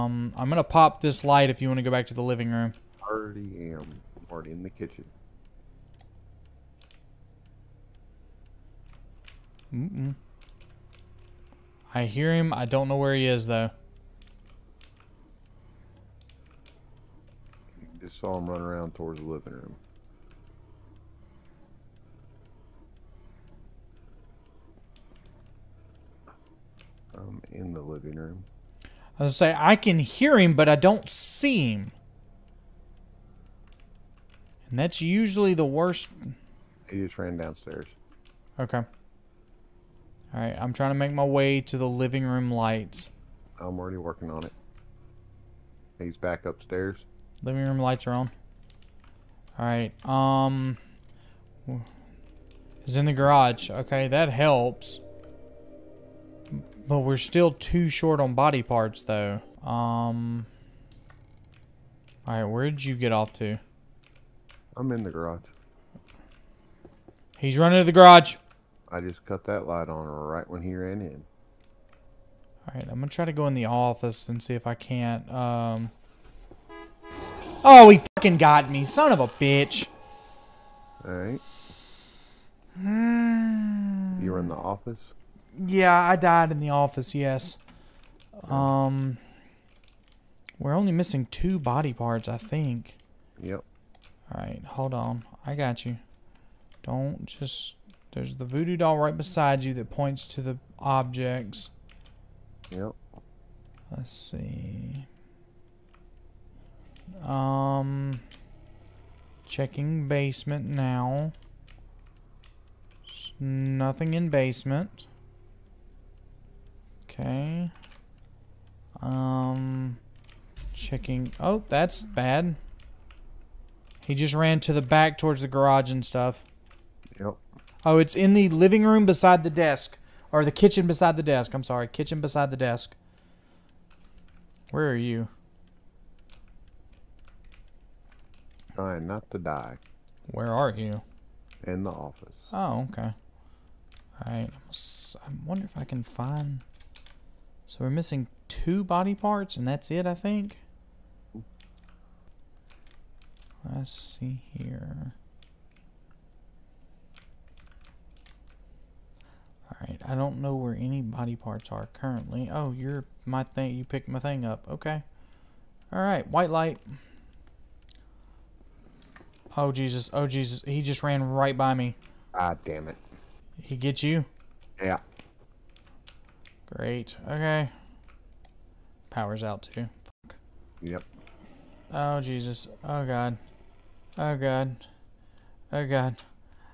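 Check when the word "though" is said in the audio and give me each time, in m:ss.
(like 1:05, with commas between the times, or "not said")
0:13, 0:59.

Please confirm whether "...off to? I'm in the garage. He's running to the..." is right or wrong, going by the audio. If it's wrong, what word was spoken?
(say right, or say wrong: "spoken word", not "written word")
right.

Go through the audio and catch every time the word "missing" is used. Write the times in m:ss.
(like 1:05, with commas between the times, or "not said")
1:30, 2:27.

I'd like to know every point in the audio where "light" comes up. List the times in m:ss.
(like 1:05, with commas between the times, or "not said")
0:01, 0:42, 0:47, 1:09, 2:46.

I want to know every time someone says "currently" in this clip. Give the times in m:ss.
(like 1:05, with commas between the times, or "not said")
2:41.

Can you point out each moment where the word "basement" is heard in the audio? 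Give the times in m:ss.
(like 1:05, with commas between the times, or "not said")
1:50, 1:54.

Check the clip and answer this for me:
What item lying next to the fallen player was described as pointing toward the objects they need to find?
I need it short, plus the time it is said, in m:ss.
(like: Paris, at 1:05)
Voodoo doll, at 1:38.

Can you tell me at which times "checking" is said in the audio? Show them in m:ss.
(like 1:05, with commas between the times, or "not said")
1:49, 2:00.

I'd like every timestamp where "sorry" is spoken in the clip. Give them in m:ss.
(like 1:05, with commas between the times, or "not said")
2:11.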